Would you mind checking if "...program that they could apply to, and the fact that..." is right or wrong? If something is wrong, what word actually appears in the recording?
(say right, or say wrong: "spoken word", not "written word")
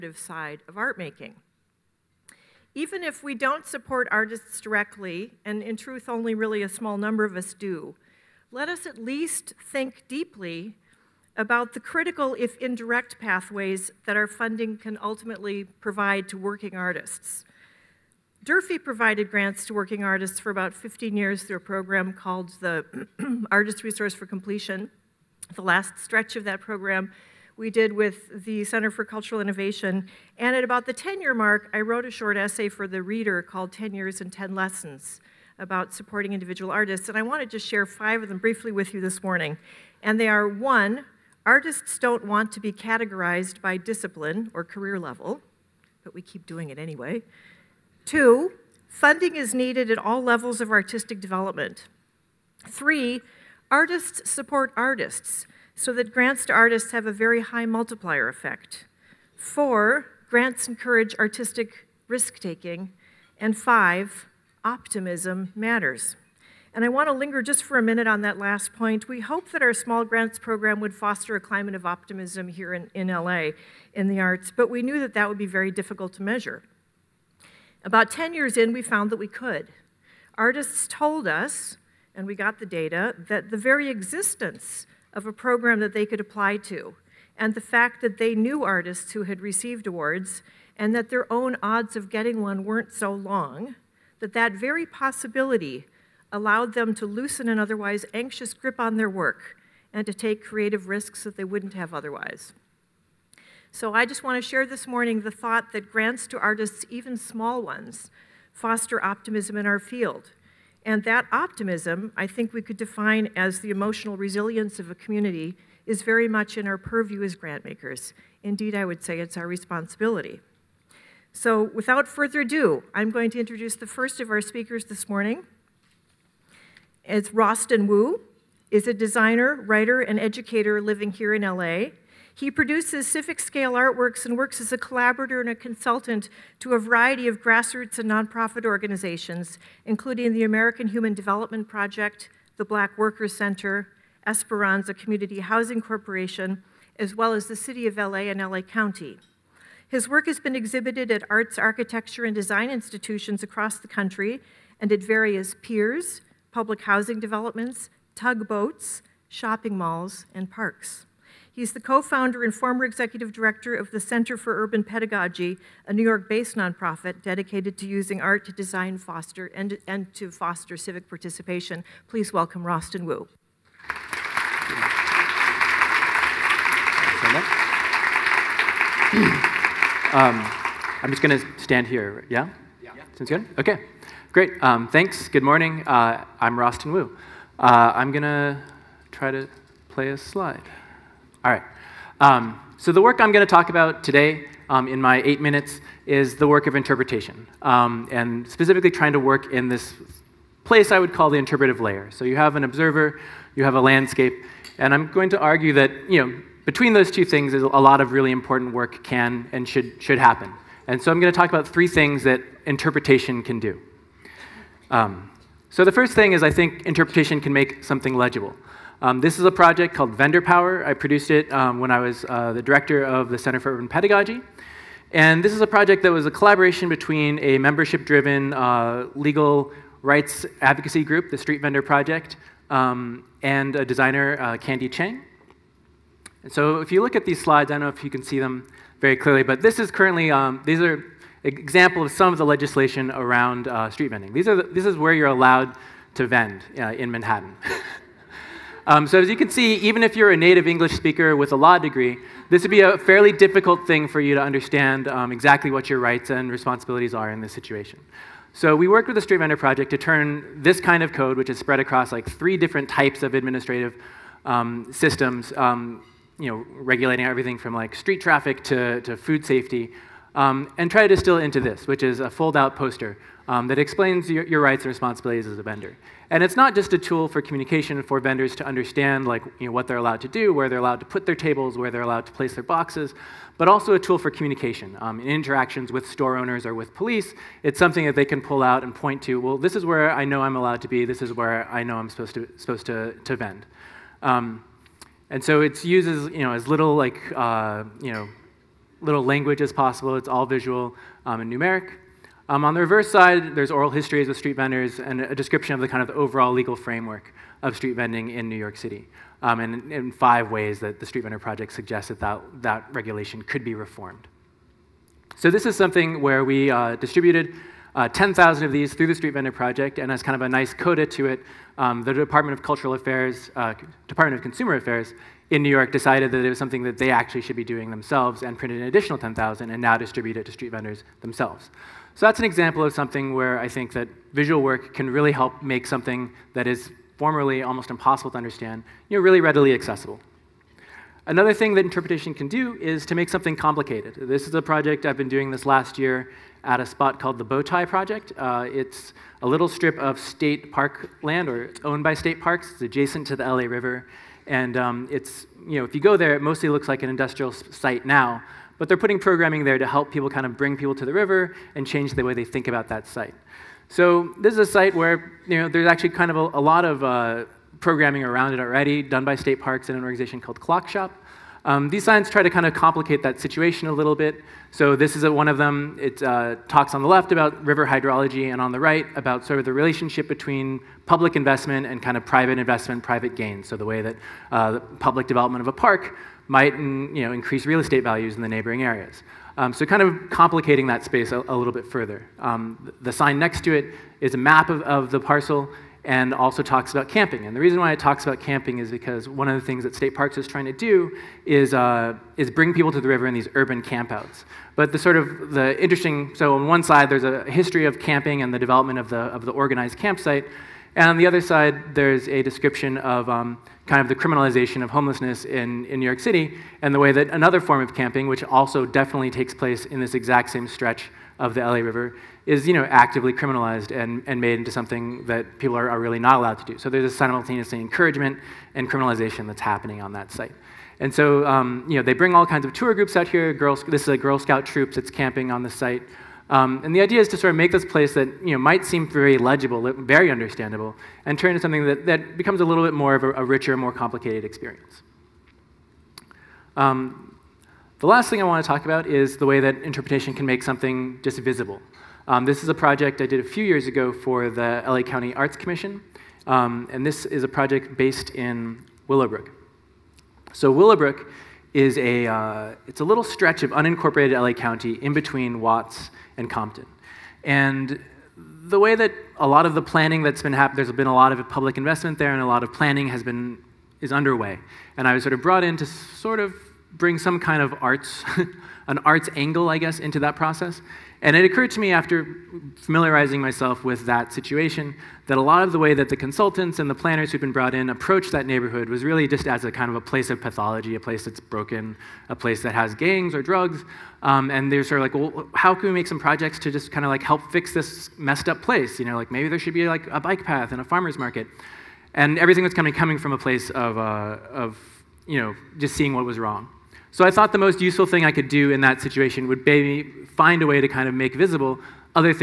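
right.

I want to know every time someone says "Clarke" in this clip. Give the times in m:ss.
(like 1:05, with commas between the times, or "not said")
not said.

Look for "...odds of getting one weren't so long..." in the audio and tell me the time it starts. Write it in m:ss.
1:31.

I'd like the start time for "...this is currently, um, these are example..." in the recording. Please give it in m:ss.
3:59.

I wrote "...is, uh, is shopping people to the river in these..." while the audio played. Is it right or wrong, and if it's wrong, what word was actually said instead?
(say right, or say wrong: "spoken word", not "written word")
wrong: "bring", not "shopping".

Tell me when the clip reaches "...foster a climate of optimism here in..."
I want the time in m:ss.
1:10.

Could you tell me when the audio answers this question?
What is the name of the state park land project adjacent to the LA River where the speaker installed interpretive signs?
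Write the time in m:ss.
5:47.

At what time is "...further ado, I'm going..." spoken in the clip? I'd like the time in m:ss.
2:02.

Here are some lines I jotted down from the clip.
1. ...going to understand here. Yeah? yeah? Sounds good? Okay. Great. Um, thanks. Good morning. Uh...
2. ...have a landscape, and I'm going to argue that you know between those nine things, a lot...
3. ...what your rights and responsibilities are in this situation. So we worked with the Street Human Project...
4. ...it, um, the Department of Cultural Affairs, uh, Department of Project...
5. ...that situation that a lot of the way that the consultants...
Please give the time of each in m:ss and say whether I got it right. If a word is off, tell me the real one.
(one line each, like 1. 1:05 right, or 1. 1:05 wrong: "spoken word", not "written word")
1. 3:01 wrong: "stand", not "understand"
2. 3:23 wrong: "two", not "nine"
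3. 4:15 wrong: "Vendor", not "Human"
4. 5:21 wrong: "Consumer", not "Project"
5. 8:04 right.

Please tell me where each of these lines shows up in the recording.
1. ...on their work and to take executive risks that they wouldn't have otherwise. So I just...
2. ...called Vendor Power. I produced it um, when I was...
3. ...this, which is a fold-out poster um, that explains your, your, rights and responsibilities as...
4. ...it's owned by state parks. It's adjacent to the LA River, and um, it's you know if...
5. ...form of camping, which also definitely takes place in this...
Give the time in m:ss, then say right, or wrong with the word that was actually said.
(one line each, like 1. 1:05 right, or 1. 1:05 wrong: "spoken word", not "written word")
1. 1:38 wrong: "creative", not "executive"
2. 3:39 right
3. 4:31 right
4. 5:51 right
5. 6:57 right.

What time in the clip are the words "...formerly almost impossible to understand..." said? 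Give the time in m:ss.
5:37.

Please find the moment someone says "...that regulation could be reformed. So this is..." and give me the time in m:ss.
5:12.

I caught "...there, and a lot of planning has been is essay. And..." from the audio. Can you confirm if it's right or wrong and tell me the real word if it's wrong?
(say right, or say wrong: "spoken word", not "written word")
wrong: "underway", not "essay".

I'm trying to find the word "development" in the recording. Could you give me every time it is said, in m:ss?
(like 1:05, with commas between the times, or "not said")
0:51, 2:21, 2:37, 6:25, 6:48.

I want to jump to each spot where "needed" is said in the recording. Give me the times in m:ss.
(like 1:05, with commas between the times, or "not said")
0:49.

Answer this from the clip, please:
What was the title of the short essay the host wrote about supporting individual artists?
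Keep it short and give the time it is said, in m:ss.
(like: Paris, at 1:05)
10 Years and 10 Lessons, at 0:33.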